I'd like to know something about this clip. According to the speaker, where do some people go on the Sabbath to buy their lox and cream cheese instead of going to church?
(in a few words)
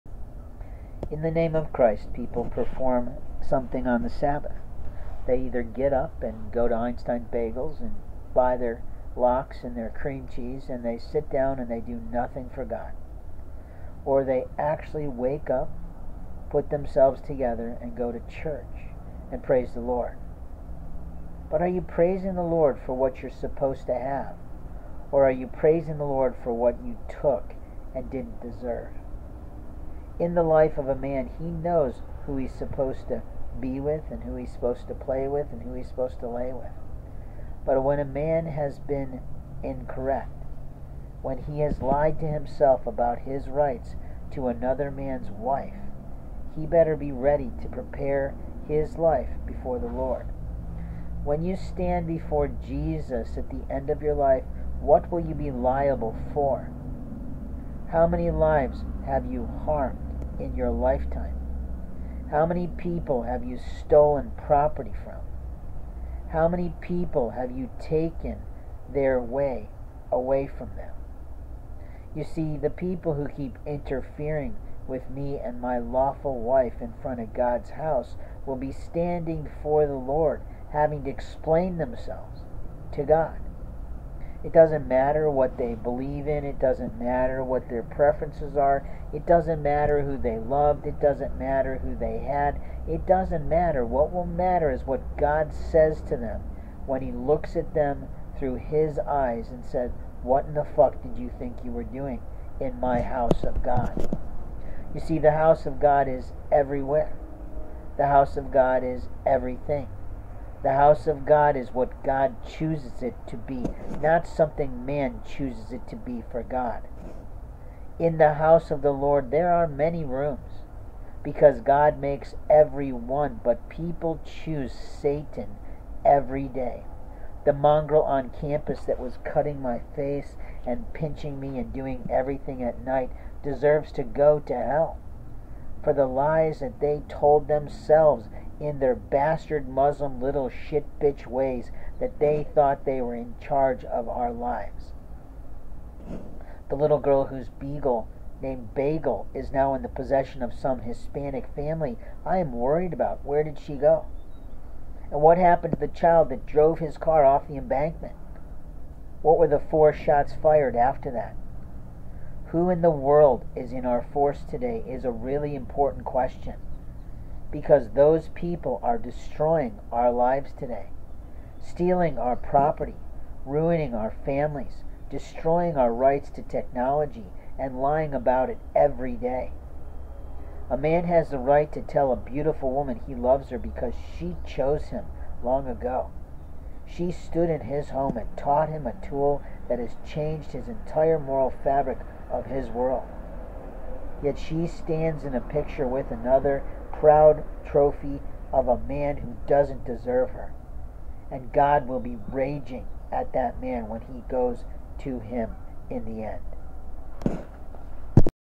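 Einstein Bagels.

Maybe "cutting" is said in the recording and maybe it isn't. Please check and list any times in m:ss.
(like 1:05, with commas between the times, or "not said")
2:09.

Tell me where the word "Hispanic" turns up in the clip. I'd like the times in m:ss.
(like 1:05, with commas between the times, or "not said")
2:30.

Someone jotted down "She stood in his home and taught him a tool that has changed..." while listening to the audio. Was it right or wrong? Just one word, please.
right.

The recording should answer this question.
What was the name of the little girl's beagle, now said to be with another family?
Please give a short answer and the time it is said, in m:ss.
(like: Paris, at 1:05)
Bagel, at 2:28.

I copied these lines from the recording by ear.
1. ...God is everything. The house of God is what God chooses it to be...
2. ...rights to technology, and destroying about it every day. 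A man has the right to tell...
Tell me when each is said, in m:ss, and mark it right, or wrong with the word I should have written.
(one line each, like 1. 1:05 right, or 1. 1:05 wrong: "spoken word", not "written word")
1. 1:48 right
2. 2:55 wrong: "lying", not "destroying".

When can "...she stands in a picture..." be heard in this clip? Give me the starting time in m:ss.
3:14.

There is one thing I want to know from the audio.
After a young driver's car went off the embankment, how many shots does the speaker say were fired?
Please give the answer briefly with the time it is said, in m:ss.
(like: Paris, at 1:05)
4, at 2:39.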